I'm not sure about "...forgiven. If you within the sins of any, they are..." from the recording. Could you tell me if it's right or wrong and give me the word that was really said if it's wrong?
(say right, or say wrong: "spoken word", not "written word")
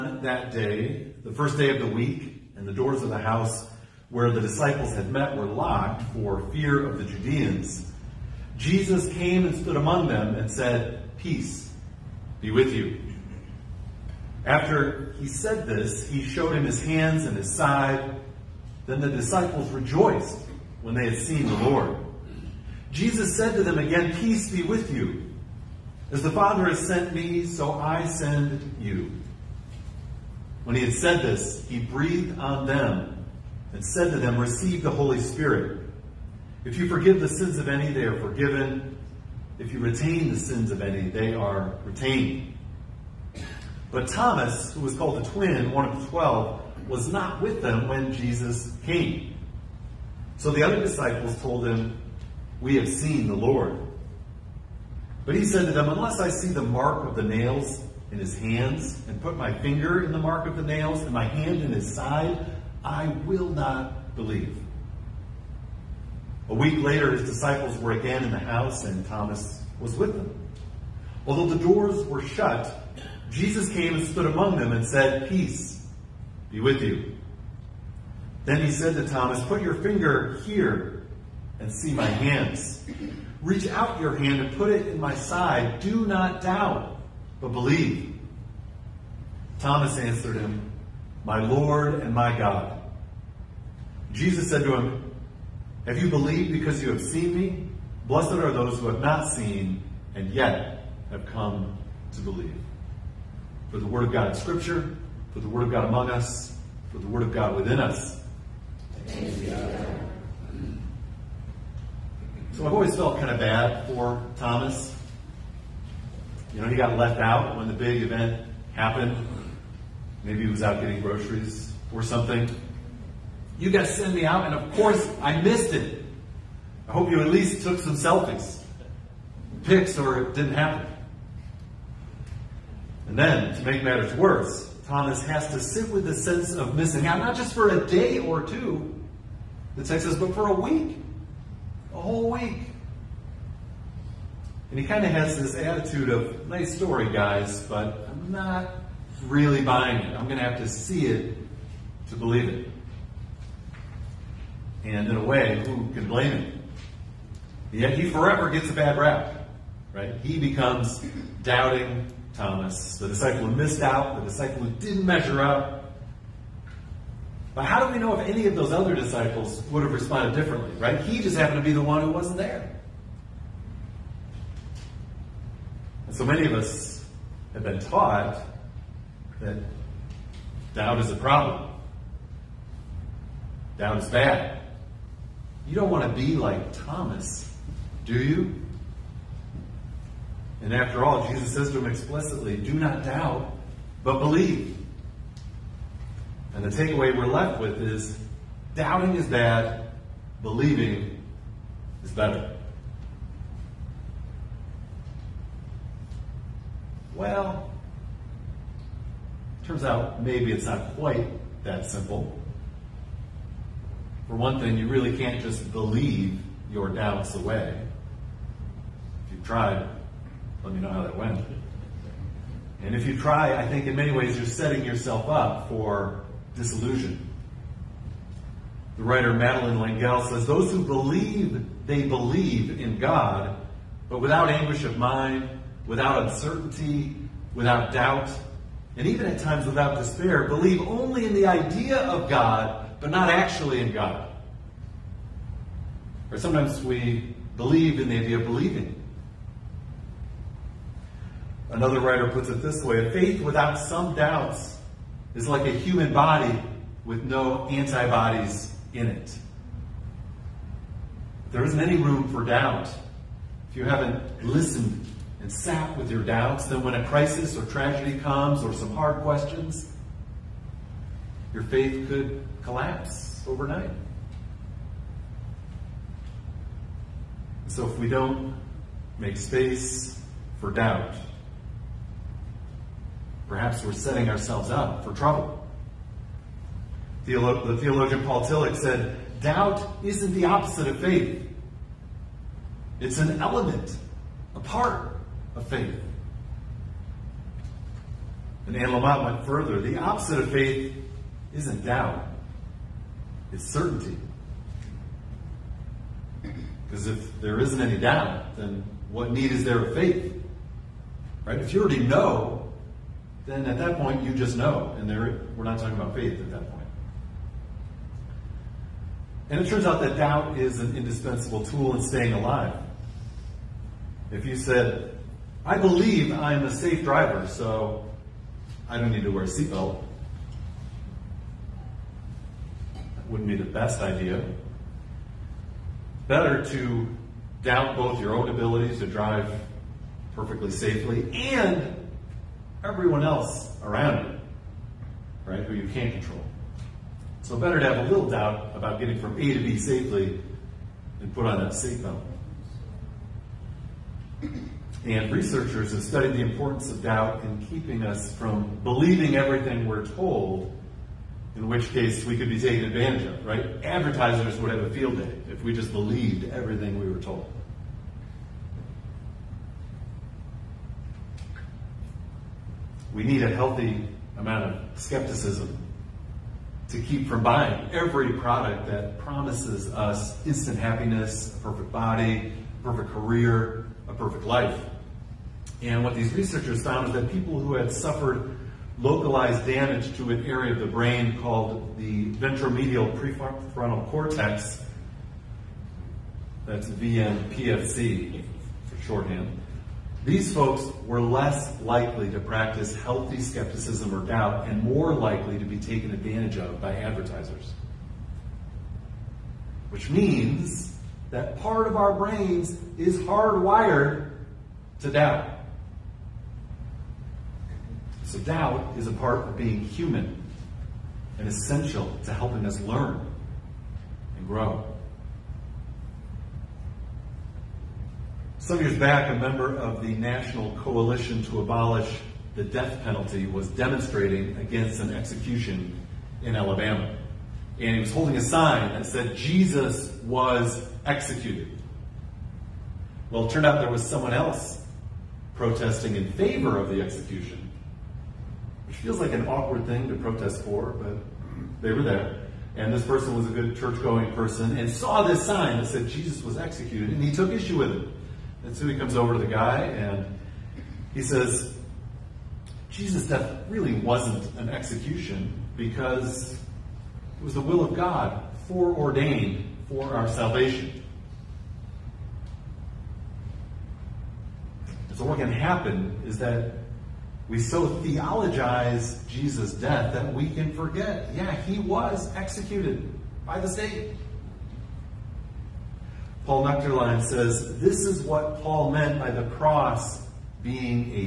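wrong: "retain", not "within".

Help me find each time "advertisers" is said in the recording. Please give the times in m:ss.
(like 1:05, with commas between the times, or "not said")
6:03, 6:46.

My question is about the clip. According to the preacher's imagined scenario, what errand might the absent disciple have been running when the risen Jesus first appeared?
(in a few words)
getting groceries.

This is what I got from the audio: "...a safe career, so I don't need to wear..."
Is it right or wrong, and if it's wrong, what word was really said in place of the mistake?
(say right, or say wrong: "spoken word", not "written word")
wrong: "driver", not "career".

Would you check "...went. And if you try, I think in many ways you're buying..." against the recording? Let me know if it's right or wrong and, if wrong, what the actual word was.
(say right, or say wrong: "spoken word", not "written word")
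wrong: "setting", not "buying".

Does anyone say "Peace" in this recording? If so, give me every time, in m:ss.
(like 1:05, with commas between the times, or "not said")
0:11, 0:24, 1:15.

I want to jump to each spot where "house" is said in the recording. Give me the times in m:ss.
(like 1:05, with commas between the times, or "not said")
0:03, 1:08.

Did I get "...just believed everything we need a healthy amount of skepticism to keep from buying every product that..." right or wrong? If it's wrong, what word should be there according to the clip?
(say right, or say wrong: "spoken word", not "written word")
right.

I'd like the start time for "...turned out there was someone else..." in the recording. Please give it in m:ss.
7:23.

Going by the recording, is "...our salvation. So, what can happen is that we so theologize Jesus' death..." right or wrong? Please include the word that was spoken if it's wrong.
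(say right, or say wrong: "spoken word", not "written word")
right.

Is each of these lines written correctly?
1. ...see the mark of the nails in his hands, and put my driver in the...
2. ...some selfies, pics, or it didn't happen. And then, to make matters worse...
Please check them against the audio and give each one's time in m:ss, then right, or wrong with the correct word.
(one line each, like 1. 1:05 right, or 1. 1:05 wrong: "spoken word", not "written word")
1. 0:56 wrong: "finger", not "driver"
2. 2:07 right.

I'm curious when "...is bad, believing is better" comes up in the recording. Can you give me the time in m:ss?
3:19.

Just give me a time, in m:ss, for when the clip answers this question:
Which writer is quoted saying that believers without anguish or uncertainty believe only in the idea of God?
3:49.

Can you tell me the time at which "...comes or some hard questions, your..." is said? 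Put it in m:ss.
4:28.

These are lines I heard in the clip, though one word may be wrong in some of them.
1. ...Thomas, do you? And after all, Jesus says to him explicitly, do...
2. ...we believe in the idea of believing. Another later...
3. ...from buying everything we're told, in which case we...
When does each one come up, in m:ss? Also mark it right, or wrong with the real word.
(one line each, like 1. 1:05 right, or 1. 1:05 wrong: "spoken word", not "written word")
1. 3:06 right
2. 4:06 wrong: "writer", not "later"
3. 5:58 wrong: "believing", not "buying".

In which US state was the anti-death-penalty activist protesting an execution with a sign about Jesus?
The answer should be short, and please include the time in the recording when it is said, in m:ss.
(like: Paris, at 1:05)
Alabama, at 7:16.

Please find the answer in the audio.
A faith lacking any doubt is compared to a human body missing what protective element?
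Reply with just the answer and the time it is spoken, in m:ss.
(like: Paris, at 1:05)
antibodies, at 4:17.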